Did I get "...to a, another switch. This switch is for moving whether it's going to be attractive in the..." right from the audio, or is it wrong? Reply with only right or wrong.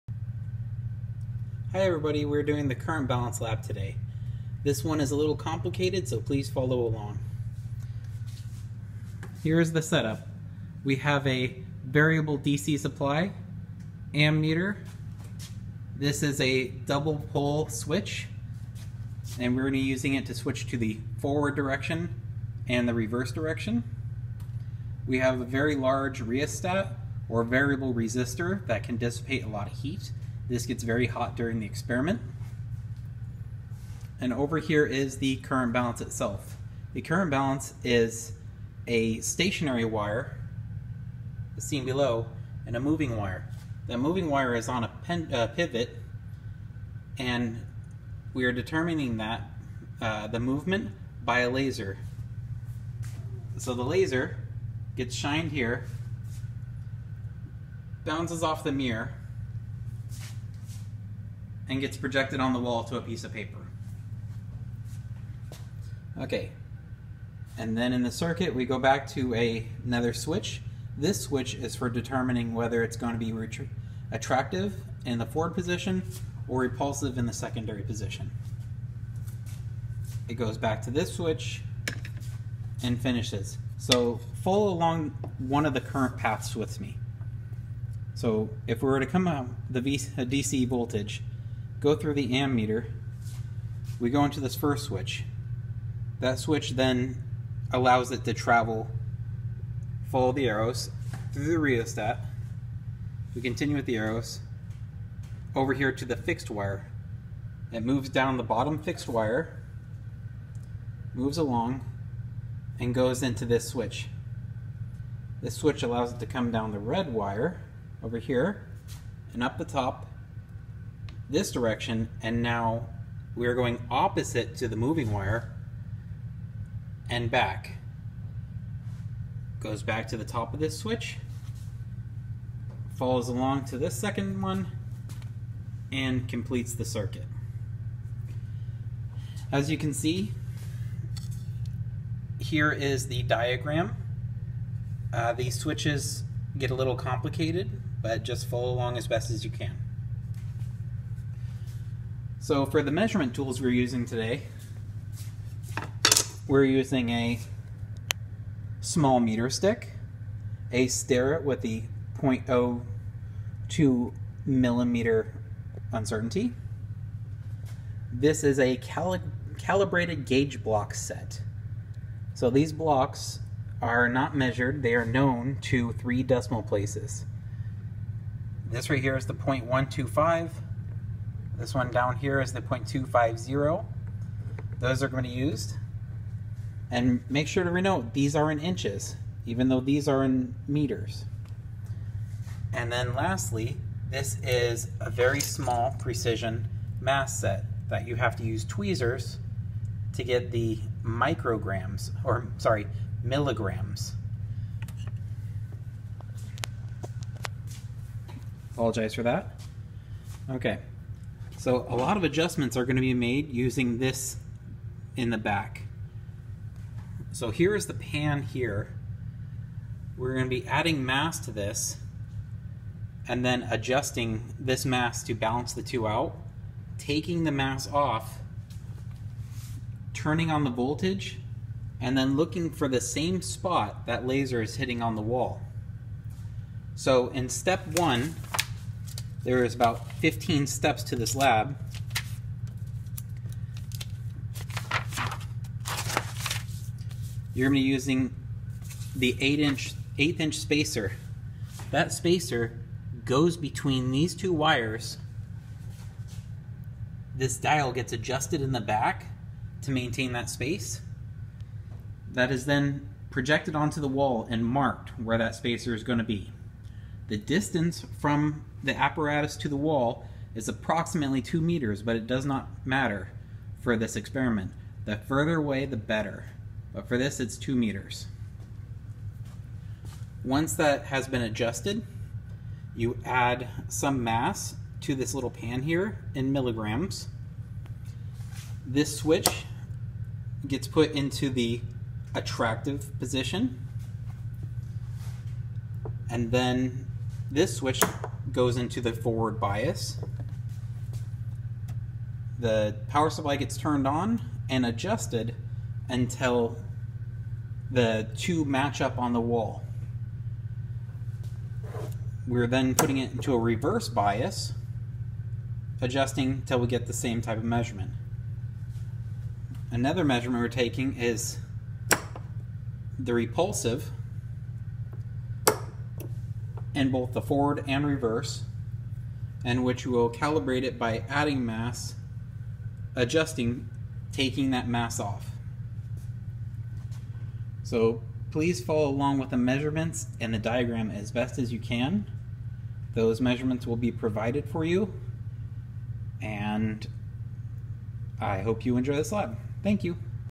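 wrong.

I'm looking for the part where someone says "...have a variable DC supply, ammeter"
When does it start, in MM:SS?
00:10.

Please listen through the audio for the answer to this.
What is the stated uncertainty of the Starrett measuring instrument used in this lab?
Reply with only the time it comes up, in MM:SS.
02:42.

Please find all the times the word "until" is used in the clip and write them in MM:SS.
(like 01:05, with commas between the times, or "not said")
05:06, 05:16.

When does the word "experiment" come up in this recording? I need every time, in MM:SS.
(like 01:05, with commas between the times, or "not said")
00:31, 04:34.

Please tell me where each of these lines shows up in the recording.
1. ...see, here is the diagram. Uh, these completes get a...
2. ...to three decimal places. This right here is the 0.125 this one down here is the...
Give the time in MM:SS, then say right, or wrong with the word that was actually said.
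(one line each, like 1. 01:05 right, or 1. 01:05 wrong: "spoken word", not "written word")
1. 02:19 wrong: "switches", not "completes"
2. 02:55 right.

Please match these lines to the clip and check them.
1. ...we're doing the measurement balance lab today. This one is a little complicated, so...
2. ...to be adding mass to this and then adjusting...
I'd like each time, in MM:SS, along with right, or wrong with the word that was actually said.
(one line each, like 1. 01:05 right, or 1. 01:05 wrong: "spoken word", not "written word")
1. 00:02 wrong: "current", not "measurement"
2. 03:40 right.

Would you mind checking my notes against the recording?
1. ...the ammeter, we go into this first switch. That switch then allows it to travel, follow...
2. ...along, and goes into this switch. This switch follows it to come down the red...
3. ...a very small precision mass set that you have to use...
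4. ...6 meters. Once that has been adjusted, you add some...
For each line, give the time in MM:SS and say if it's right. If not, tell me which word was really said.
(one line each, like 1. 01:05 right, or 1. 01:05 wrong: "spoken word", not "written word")
1. 01:32 right
2. 01:51 wrong: "allows", not "follows"
3. 03:15 right
4. 04:37 wrong: "2", not "6".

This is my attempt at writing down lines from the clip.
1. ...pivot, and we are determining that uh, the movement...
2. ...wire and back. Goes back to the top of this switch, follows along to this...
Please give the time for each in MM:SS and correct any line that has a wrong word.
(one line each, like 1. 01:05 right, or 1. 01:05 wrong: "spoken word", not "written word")
1. 00:45 right
2. 02:05 right.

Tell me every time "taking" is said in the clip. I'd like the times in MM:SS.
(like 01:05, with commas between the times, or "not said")
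03:46, 05:20, 05:34.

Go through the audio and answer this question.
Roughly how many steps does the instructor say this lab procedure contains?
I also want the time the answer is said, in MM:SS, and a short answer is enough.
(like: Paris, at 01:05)
15, at 04:00.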